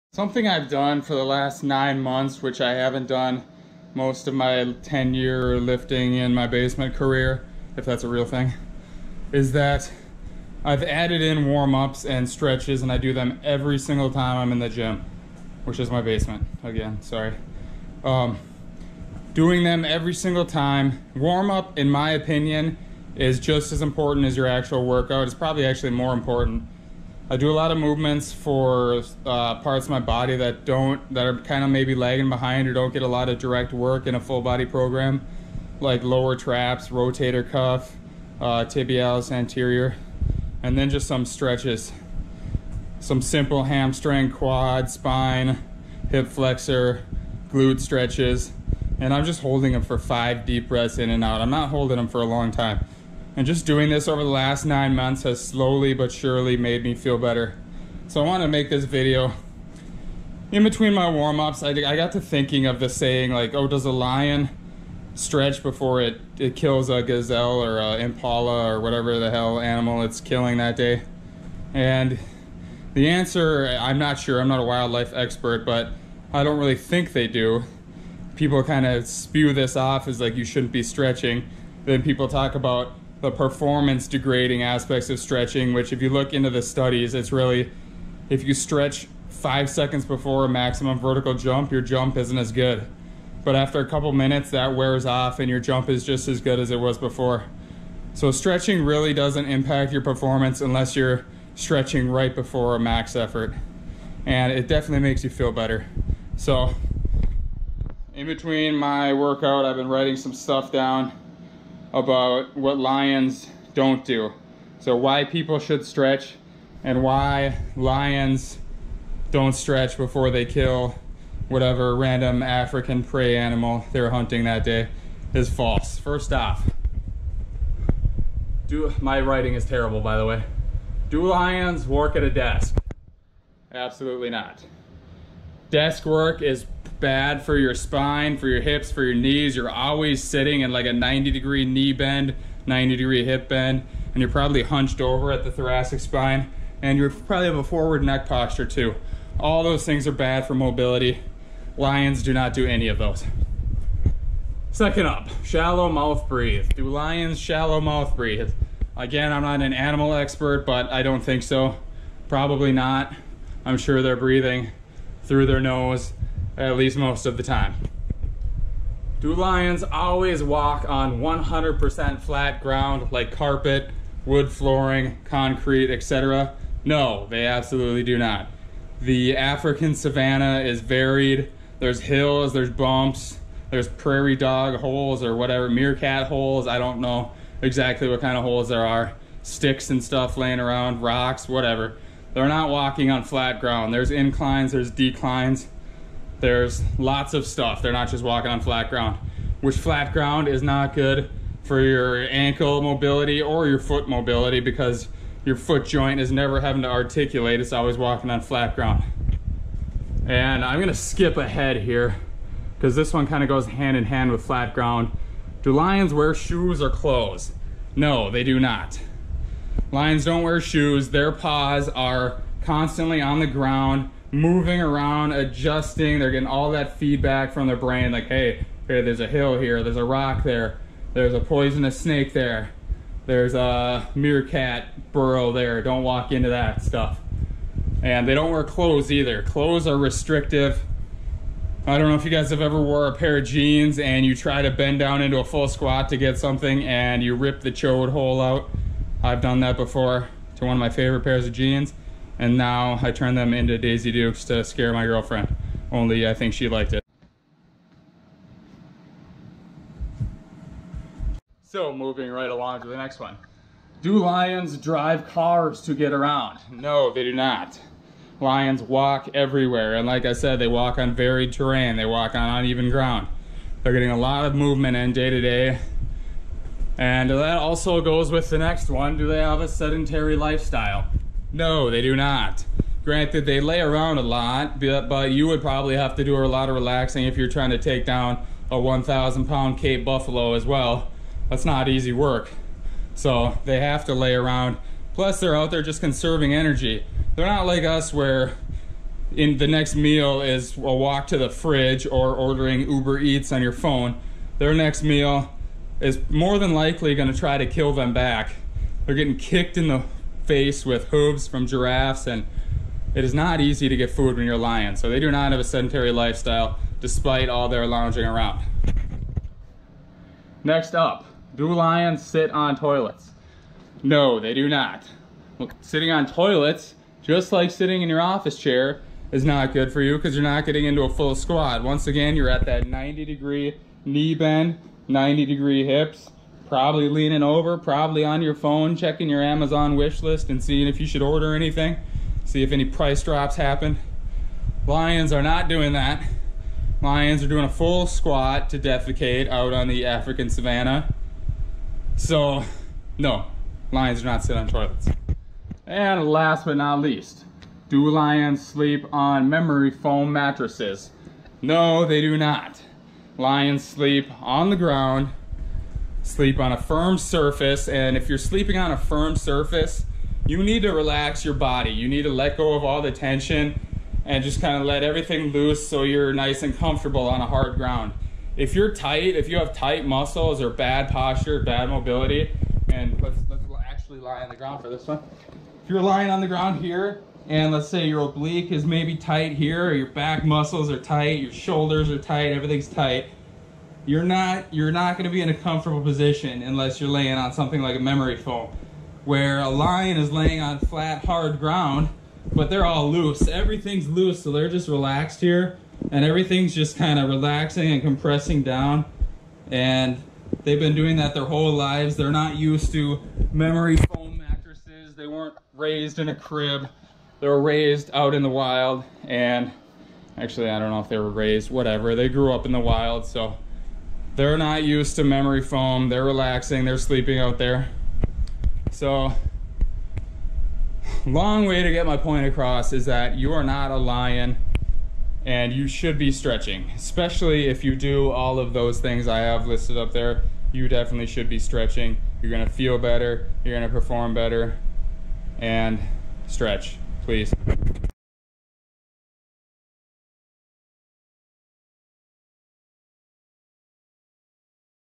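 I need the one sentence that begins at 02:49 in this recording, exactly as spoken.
Do lions always walk on 100% flat ground like carpet, wood flooring, concrete, etc.?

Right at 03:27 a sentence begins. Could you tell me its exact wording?
It's always walking on flat ground.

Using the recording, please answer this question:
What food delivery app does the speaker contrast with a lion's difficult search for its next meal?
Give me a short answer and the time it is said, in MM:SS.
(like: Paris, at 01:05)
Uber Eats, at 05:02.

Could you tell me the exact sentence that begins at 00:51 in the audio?
I'm not holding them for a long time.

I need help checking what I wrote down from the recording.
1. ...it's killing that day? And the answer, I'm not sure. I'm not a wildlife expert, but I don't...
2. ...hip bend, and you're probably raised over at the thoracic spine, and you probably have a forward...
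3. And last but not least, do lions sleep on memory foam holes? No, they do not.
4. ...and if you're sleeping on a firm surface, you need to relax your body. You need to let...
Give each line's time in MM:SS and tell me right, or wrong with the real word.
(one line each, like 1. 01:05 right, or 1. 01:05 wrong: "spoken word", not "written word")
1. 01:10 right
2. 02:23 wrong: "hunched", not "raised"
3. 05:55 wrong: "mattresses", not "holes"
4. 06:07 right.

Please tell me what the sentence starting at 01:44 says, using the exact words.
And it definitely makes you feel better.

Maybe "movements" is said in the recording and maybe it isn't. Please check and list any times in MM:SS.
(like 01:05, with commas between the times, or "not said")
00:27, 04:34.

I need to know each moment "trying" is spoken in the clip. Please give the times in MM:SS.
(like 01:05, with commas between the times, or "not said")
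04:47.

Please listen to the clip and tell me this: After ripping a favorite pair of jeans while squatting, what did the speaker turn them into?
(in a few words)
Daisy Dukes.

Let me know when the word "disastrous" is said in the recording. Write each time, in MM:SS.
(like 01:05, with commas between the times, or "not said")
not said.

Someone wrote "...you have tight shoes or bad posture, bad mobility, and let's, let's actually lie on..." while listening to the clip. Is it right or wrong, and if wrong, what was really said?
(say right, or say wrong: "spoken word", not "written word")
wrong: "muscles", not "shoes".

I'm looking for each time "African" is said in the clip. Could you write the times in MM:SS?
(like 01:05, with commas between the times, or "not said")
02:02, 02:59, 05:50.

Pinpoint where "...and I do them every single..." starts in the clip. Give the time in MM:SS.
00:12.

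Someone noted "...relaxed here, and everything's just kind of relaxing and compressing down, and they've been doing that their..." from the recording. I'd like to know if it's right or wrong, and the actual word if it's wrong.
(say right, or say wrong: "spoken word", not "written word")
right.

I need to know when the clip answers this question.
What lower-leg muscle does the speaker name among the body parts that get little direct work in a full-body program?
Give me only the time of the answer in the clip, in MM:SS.
00:38.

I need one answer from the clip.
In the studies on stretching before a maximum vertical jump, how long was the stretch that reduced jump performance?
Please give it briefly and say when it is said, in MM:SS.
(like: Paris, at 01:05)
5 seconds, at 01:29.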